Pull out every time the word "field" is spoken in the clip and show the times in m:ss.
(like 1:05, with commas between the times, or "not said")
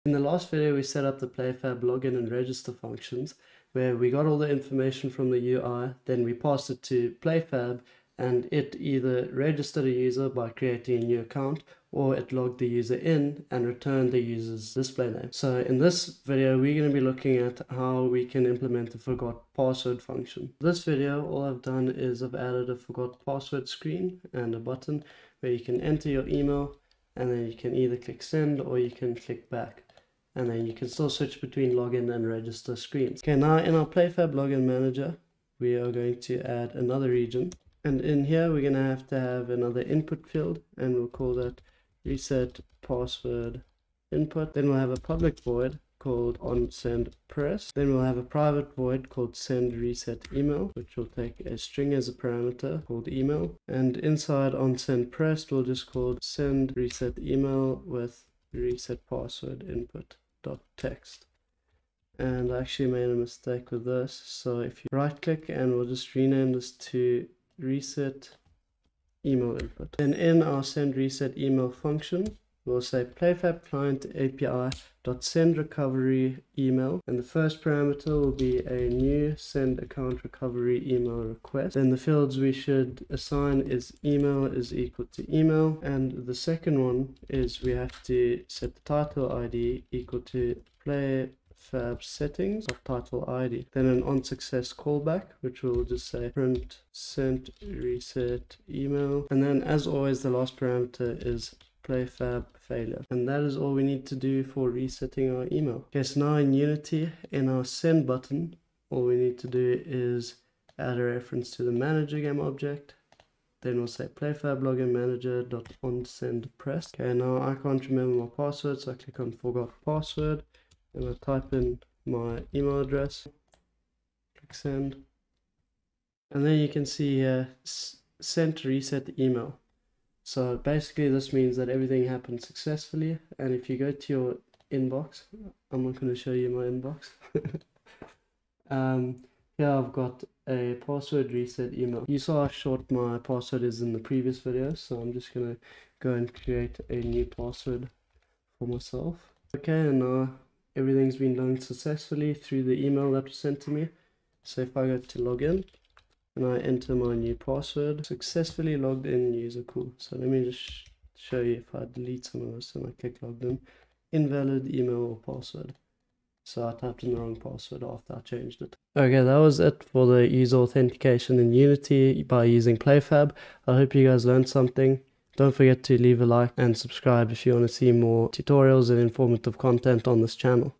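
0:40, 1:21.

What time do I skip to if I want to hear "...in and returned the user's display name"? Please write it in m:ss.
0:12.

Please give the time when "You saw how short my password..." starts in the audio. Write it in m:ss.
2:22.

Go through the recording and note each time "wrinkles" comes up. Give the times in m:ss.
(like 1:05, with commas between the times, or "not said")
not said.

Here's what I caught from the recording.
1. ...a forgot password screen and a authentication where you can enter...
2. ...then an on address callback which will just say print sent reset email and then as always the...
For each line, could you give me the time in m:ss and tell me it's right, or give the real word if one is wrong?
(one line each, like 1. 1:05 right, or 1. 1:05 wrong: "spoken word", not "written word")
1. 0:22 wrong: "button", not "authentication"
2. 1:33 wrong: "success", not "address".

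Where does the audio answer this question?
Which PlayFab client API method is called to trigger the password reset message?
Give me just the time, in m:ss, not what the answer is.
1:15.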